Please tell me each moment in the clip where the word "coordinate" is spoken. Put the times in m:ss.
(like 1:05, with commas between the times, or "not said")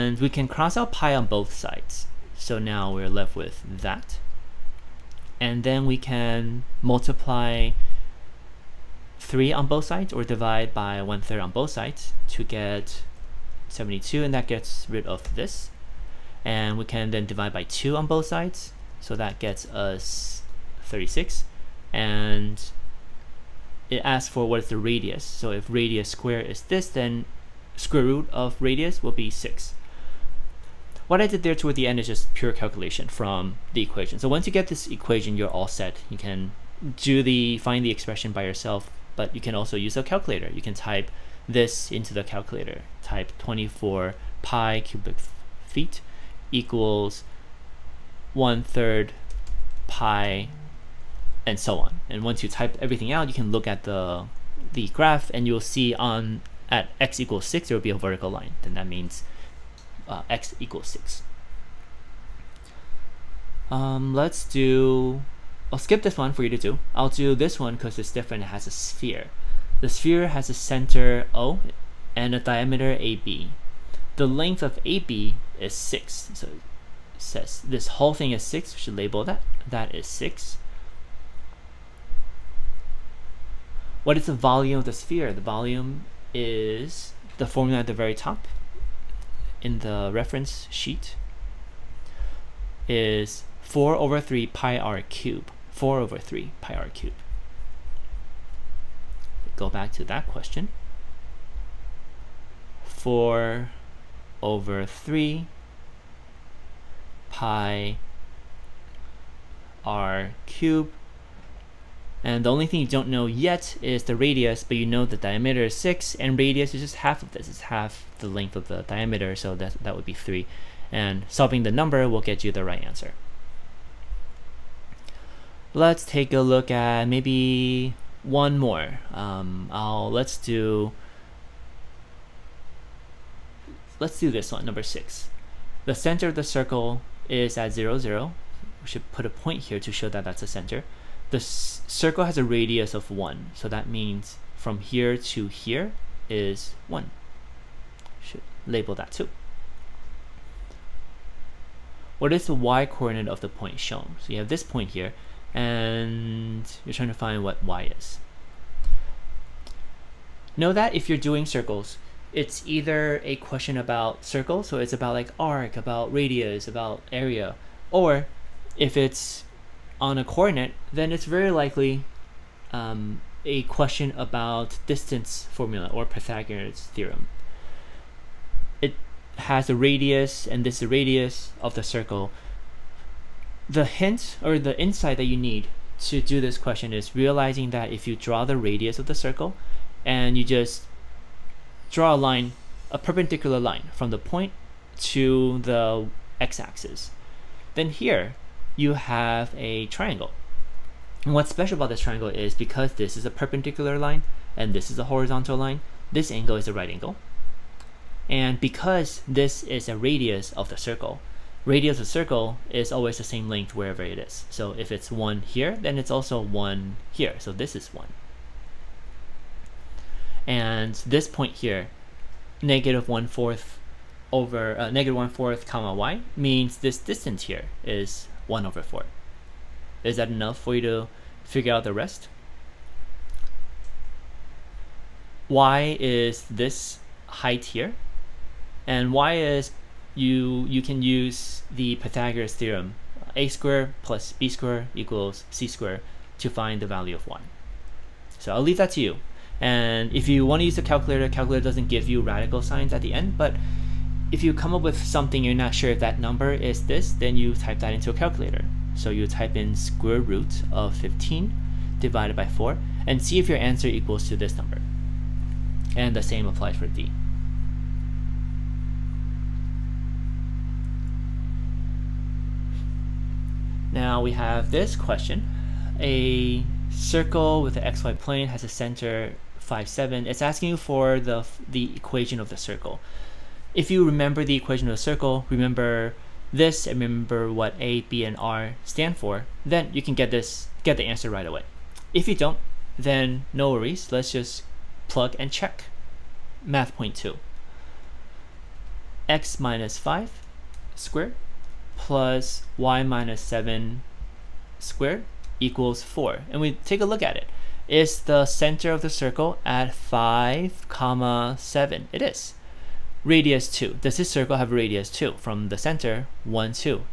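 2:32, 2:50.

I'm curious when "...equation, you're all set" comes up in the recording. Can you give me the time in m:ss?
0:34.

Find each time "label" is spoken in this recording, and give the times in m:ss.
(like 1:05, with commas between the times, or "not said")
1:18, 2:28.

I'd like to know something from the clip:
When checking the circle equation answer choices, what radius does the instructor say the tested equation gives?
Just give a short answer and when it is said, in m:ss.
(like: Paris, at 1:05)
2, at 5:12.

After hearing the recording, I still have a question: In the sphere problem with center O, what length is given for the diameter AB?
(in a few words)
6.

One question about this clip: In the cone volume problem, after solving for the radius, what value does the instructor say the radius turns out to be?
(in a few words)
6.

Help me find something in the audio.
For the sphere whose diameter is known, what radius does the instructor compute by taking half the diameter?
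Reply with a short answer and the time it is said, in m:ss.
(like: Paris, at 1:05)
3, at 1:59.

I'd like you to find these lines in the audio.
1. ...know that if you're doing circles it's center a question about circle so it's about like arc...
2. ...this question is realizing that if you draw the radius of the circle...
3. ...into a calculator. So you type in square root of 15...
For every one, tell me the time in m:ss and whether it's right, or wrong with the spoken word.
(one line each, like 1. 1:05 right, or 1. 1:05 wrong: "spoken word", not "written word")
1. 2:40 wrong: "either", not "center"
2. 3:06 right
3. 4:17 right.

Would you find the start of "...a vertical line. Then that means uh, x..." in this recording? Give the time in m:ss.
0:57.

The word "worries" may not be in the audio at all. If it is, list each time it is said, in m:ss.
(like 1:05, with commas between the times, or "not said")
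4:53.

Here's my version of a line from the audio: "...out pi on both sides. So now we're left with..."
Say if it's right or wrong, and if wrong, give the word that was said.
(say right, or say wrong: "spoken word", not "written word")
right.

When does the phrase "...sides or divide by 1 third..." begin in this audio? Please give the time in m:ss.
0:09.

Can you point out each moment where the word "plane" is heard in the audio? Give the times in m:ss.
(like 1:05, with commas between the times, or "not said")
4:38.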